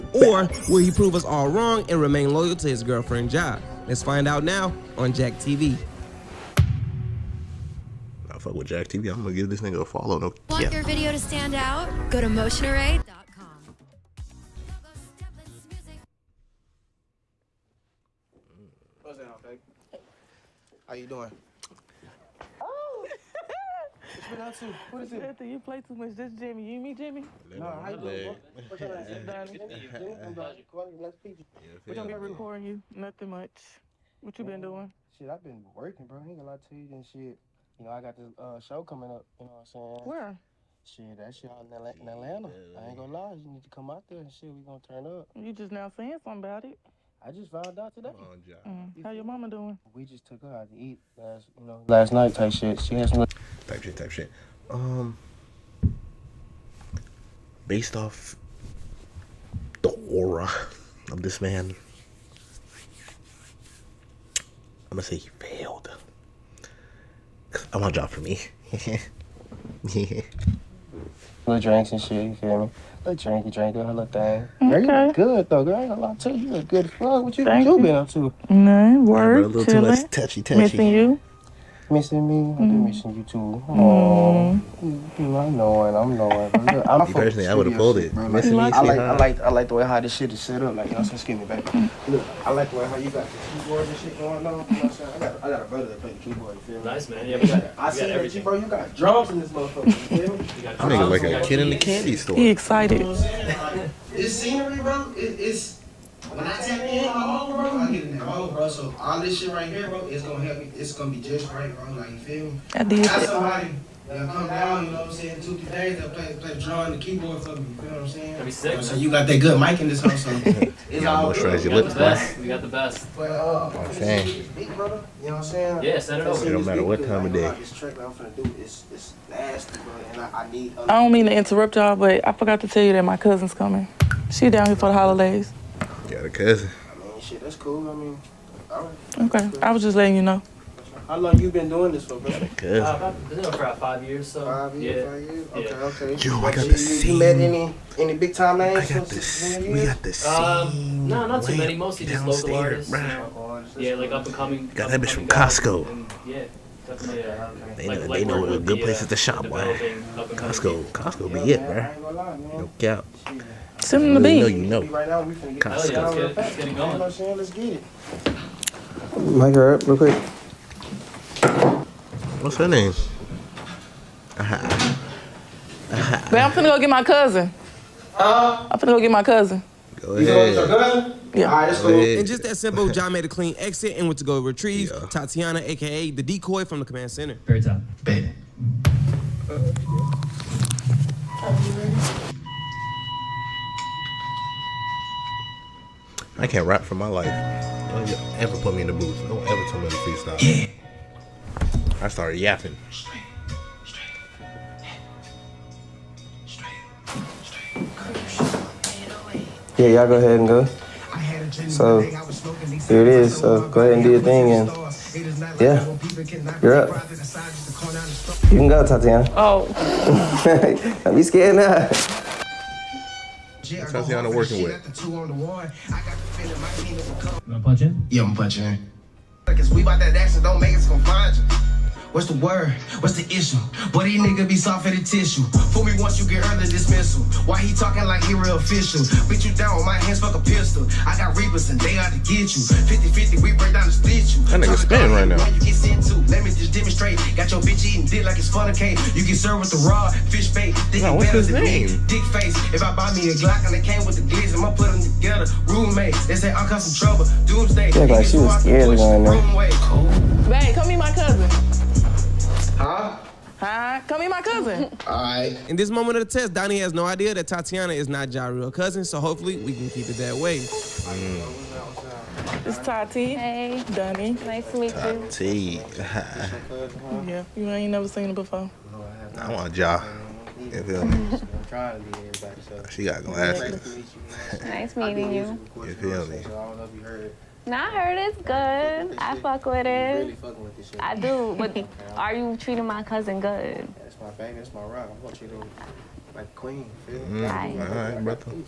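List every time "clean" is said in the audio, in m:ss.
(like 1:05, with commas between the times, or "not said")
3:03.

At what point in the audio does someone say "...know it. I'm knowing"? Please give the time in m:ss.
1:25.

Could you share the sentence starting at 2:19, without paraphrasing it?
I was just letting you know.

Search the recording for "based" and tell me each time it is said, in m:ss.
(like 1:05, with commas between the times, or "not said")
0:57.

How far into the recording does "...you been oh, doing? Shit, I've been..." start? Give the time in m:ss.
0:34.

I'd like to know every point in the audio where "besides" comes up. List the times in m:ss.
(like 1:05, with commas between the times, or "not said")
not said.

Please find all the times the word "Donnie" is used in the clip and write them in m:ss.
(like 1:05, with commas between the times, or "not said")
4:26, 4:33.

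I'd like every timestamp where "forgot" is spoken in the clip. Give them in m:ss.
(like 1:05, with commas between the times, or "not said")
2:12.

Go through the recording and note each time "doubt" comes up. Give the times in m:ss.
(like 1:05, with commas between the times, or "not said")
2:42.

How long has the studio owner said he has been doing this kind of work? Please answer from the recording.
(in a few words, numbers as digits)
5 years.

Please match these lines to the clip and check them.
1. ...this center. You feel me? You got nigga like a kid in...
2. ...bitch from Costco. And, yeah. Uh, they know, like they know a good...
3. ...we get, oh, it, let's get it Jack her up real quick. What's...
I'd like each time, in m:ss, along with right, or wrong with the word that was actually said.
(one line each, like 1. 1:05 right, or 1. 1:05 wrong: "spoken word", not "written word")
1. 1:39 wrong: "motherfucker", not "center"
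2. 2:35 right
3. 2:45 wrong: "Mic", not "Jack".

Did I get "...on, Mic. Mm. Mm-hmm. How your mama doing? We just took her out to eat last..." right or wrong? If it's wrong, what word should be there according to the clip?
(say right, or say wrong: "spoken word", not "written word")
wrong: "John", not "Mic".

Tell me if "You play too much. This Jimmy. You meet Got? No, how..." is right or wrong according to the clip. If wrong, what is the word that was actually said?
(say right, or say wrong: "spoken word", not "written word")
wrong: "Jimmy", not "Got".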